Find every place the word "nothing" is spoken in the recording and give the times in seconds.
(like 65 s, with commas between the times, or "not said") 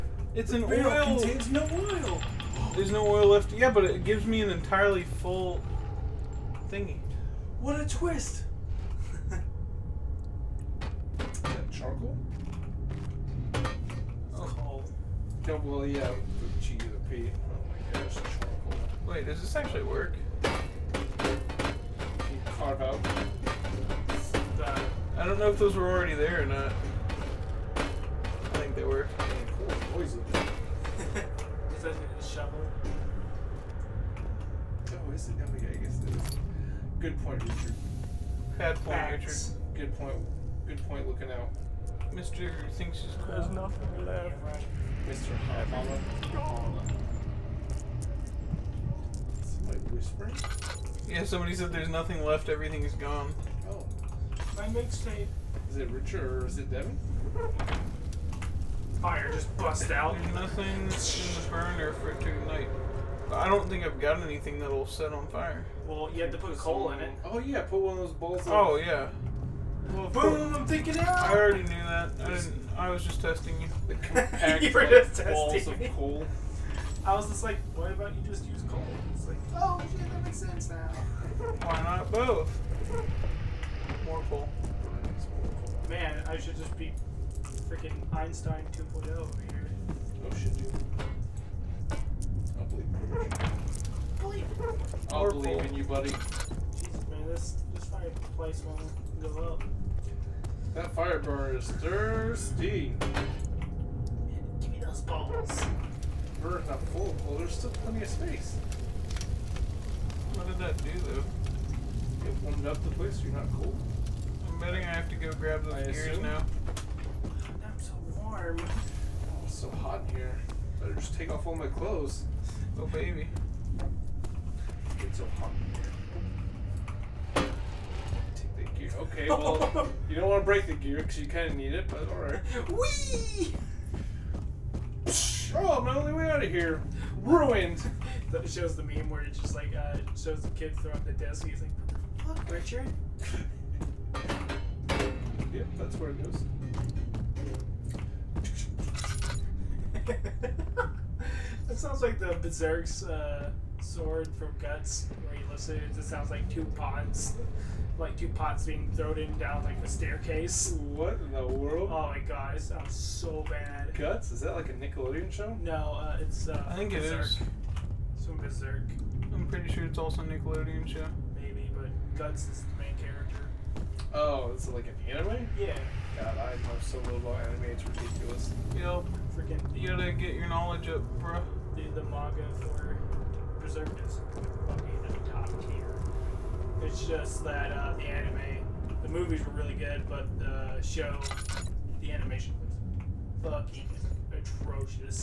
43 s, 51 s, 60 s.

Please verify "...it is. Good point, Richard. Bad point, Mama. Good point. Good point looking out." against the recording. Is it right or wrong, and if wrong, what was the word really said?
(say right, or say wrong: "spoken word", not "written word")
wrong: "Richard", not "Mama".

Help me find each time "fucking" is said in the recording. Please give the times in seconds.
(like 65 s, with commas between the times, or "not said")
184 s, 193 s.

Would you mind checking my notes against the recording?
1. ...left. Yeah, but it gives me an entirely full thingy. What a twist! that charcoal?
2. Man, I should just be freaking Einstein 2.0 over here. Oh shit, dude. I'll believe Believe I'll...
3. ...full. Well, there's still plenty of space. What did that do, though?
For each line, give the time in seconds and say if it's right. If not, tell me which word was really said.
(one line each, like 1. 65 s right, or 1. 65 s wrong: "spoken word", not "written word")
1. 3 s right
2. 85 s right
3. 106 s right.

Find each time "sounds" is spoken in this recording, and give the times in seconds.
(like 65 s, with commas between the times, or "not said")
151 s, 156 s, 162 s.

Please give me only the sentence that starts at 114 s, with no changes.
I'm betting I have to go grab those I gears assume?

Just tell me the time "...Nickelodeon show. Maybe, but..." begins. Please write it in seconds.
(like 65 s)
170 s.